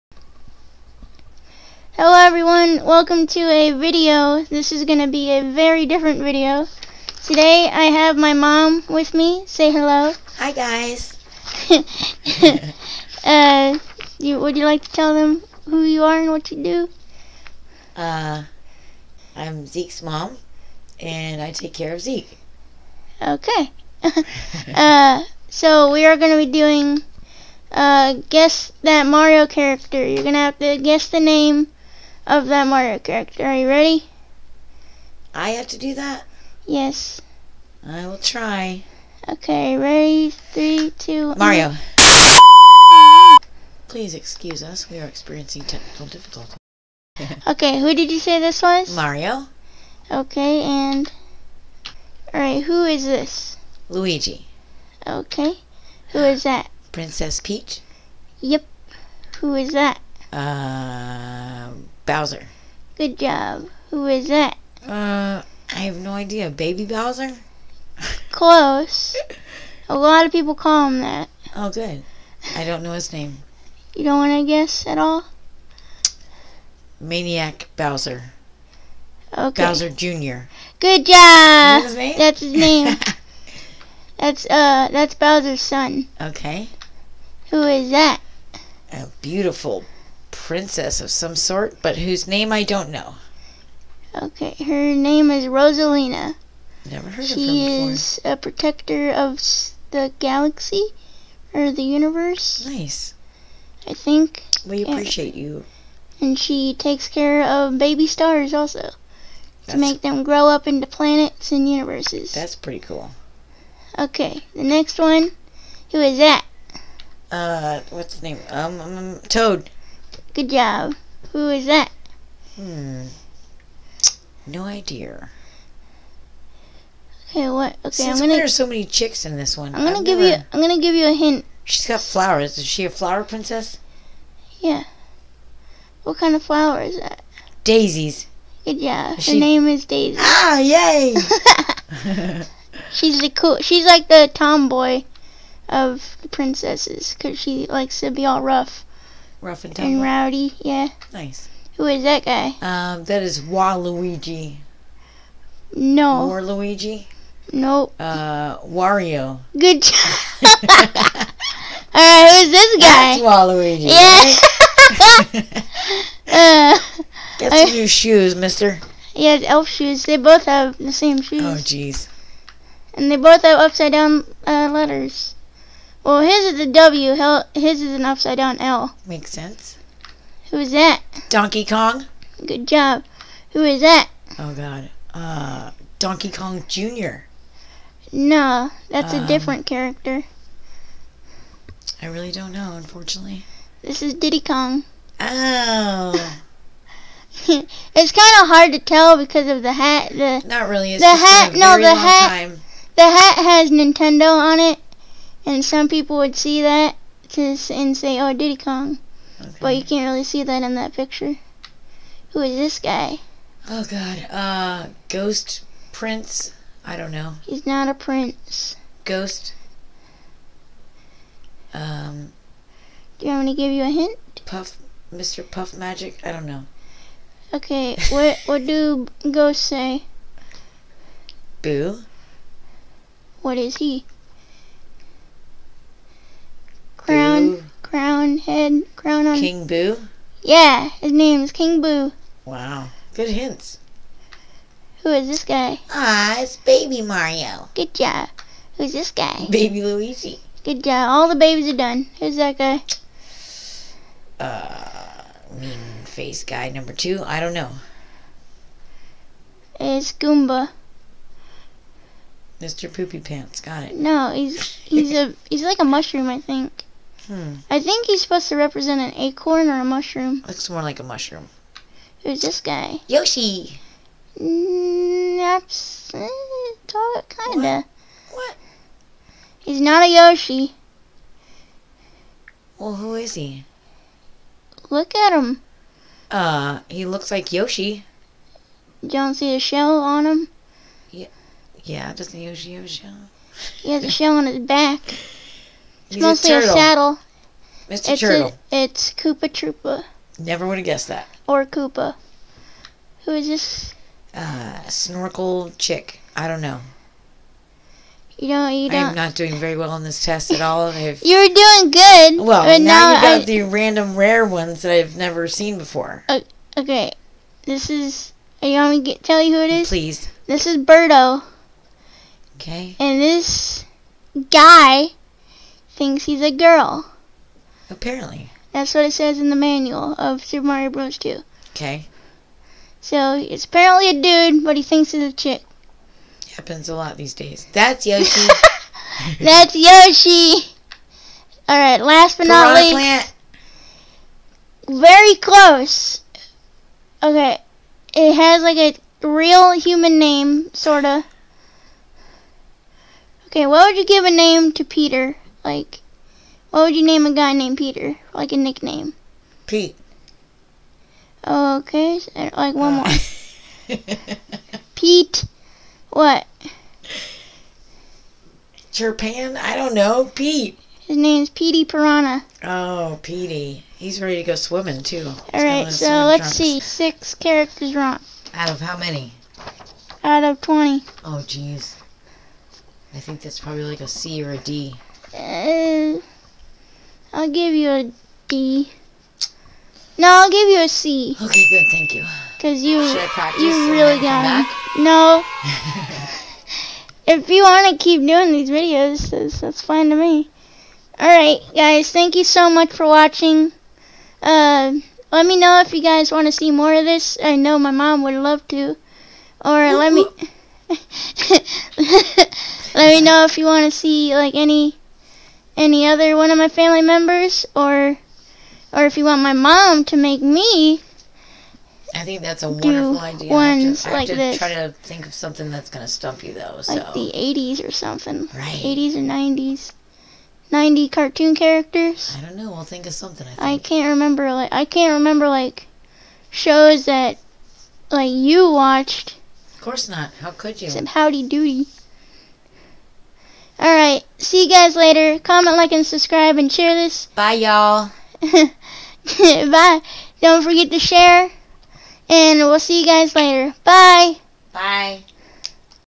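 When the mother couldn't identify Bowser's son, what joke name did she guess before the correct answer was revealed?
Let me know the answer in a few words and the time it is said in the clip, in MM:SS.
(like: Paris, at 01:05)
Maniac Bowser, at 01:16.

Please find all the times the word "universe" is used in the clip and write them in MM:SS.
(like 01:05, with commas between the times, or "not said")
01:41, 01:51.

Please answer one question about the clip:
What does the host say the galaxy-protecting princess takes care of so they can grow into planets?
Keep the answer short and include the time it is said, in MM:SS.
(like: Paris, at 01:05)
baby stars, at 01:47.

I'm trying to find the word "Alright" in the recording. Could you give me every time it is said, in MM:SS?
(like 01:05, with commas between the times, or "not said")
00:52, 02:41, 06:41, 07:23.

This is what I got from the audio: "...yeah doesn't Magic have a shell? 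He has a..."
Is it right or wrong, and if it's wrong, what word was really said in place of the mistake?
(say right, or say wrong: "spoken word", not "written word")
wrong: "Yoshi", not "Magic".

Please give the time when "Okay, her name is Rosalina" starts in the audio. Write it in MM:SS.
01:34.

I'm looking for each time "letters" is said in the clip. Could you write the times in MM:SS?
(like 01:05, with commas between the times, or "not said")
02:54.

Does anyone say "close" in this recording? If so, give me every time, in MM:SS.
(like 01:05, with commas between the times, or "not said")
01:08, 05:45.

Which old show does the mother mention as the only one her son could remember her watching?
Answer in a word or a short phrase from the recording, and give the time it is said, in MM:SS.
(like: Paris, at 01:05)
Howdy Doody, at 07:21.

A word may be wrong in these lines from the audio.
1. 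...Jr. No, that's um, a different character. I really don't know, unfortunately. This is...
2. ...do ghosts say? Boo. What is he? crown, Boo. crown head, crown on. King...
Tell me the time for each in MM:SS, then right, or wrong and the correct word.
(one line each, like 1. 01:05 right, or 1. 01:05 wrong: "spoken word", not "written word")
1. 03:06 right
2. 03:48 right.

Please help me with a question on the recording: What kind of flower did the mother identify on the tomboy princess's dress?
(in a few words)
Daisies.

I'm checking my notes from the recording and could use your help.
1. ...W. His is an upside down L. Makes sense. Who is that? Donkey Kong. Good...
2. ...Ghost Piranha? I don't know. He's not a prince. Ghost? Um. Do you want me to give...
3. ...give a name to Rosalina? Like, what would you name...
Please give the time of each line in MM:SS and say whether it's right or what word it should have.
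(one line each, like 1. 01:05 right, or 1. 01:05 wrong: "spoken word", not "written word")
1. 02:56 right
2. 03:35 wrong: "Prince", not "Piranha"
3. 05:54 wrong: "Peter", not "Rosalina".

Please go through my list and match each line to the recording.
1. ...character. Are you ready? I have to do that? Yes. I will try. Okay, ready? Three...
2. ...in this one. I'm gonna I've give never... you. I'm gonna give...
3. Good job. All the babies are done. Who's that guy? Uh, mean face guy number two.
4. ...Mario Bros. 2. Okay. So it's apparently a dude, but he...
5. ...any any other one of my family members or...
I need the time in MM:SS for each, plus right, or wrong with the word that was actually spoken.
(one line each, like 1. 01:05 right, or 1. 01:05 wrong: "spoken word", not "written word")
1. 00:32 right
2. 02:09 right
3. 04:10 right
4. 05:30 right
5. 06:54 right.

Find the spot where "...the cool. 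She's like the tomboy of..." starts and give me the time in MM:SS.
02:23.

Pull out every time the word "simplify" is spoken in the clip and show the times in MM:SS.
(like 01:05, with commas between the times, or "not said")
not said.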